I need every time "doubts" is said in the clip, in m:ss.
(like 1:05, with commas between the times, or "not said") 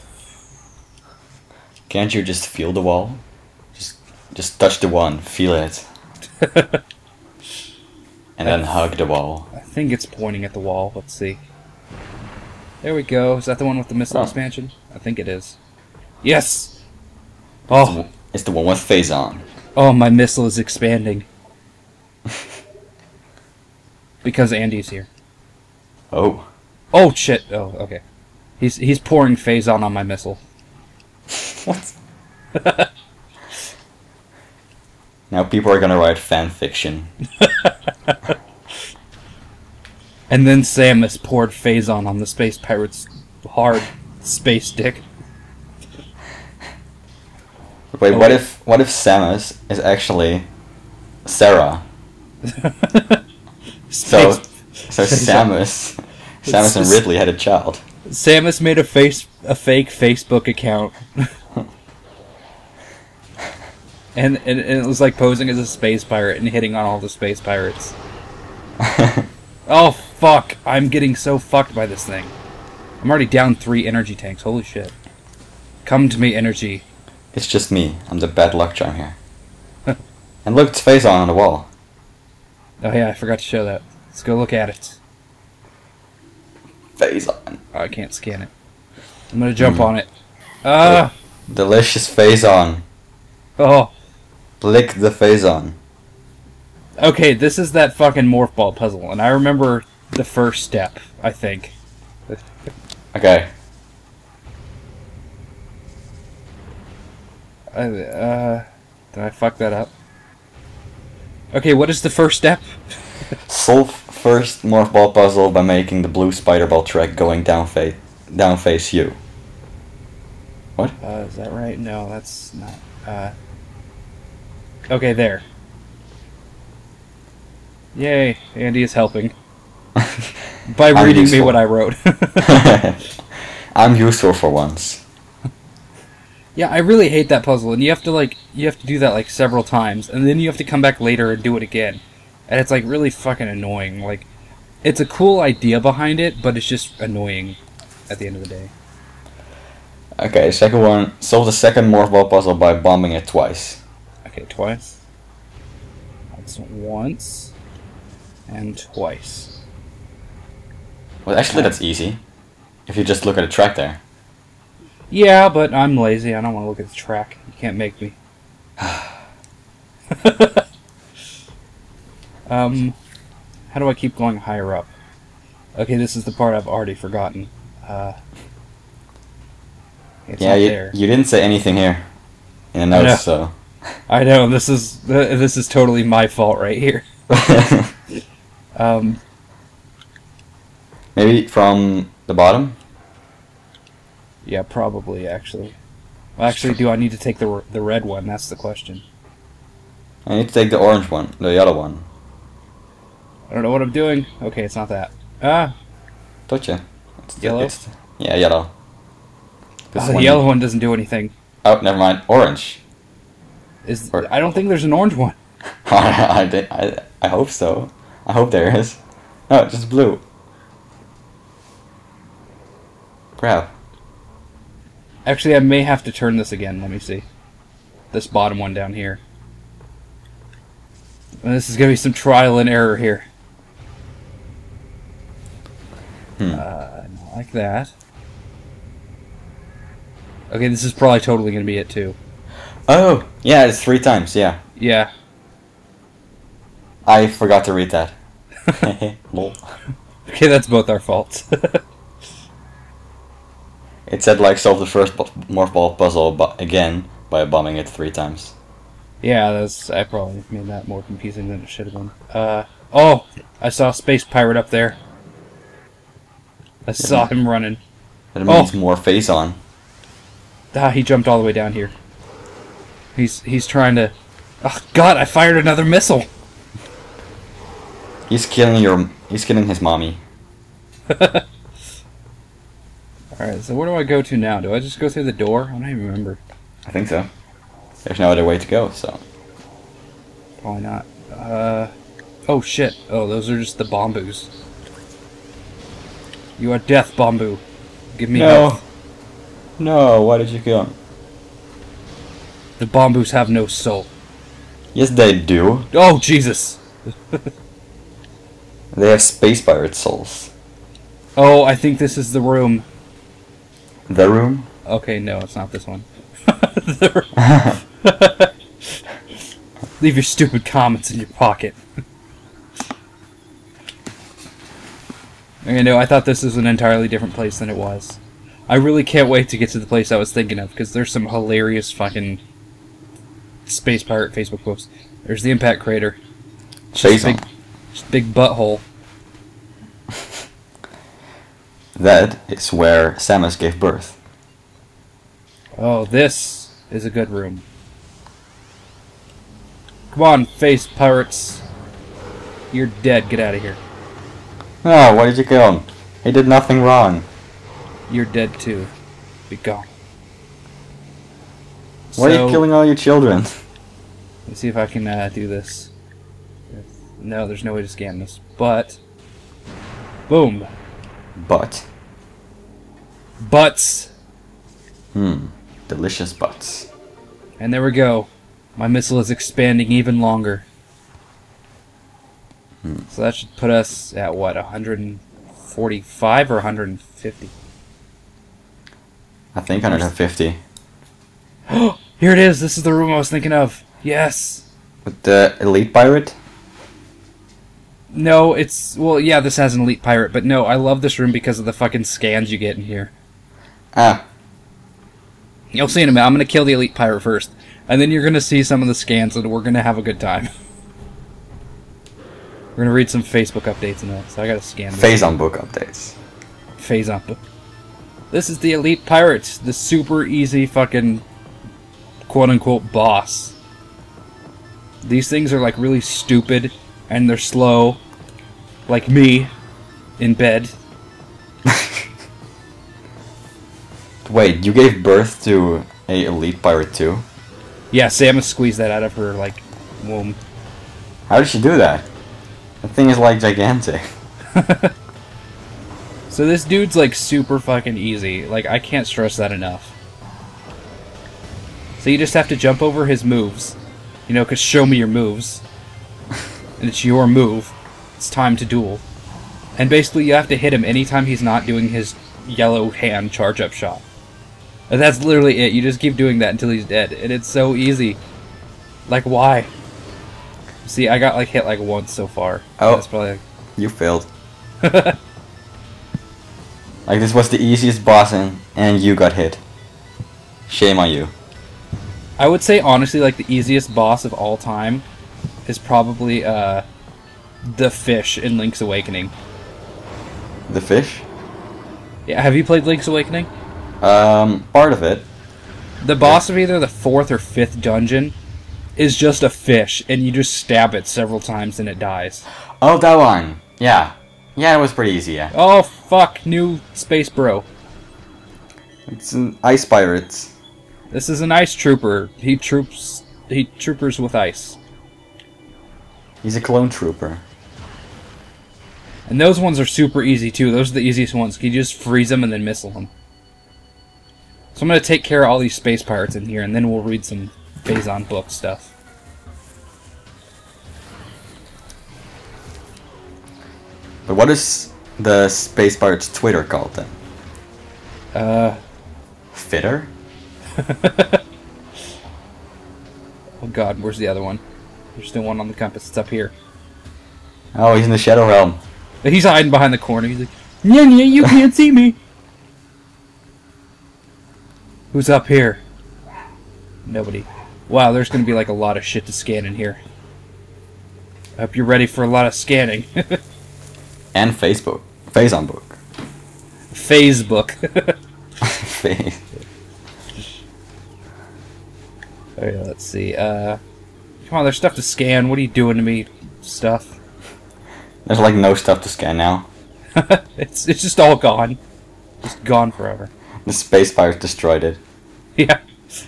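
not said.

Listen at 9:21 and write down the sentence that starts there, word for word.
I hope you're ready for a lot of scanning.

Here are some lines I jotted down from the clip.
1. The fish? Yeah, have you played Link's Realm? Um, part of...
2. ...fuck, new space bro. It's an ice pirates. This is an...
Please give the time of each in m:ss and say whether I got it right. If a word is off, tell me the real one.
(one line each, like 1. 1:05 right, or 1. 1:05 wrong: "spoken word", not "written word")
1. 8:10 wrong: "Awakening", not "Realm"
2. 8:25 right.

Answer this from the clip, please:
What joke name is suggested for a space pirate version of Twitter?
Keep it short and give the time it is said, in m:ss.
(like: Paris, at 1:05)
Fitter, at 8:59.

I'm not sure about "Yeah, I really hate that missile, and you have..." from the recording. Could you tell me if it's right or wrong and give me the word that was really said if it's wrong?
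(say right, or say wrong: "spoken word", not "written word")
wrong: "puzzle", not "missile".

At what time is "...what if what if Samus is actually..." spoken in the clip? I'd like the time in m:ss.
0:48.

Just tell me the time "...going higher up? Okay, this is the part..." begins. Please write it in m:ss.
2:54.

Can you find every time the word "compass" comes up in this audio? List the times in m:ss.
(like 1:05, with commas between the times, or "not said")
9:05.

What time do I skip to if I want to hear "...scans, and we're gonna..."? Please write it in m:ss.
6:48.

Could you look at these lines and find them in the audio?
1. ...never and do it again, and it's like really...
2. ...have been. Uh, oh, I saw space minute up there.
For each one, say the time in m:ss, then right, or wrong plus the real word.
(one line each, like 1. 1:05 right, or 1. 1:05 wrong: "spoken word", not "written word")
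1. 2:20 wrong: "later", not "never"
2. 4:21 wrong: "pirate", not "minute".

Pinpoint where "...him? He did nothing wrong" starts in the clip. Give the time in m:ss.
5:55.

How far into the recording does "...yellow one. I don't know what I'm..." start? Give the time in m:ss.
3:21.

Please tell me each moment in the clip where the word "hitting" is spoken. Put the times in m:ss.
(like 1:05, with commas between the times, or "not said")
1:06.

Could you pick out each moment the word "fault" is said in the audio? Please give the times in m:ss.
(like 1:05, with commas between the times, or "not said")
3:06, 4:10.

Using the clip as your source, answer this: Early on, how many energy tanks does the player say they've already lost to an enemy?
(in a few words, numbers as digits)
3.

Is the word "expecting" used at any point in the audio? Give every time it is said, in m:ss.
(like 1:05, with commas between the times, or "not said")
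not said.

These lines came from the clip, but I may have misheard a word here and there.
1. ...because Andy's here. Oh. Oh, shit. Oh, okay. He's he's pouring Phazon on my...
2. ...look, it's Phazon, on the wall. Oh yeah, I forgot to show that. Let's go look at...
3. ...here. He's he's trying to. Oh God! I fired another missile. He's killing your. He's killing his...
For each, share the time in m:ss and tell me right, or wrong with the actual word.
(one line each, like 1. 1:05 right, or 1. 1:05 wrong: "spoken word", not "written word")
1. 0:24 right
2. 1:20 right
3. 4:31 right.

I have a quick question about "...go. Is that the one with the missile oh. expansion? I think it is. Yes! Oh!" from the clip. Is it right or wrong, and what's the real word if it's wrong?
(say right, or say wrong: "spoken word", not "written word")
right.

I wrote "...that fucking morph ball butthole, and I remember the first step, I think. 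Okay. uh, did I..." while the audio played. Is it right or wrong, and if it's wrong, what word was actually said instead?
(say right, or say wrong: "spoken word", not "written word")
wrong: "puzzle", not "butthole".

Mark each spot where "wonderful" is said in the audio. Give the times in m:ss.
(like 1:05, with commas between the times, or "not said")
not said.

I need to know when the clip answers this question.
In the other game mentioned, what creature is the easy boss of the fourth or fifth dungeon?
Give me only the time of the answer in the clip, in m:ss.
8:19.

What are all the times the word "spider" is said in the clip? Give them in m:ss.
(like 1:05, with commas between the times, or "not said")
1:56.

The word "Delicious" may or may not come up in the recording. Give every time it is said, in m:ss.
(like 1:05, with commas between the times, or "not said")
1:31, 6:15.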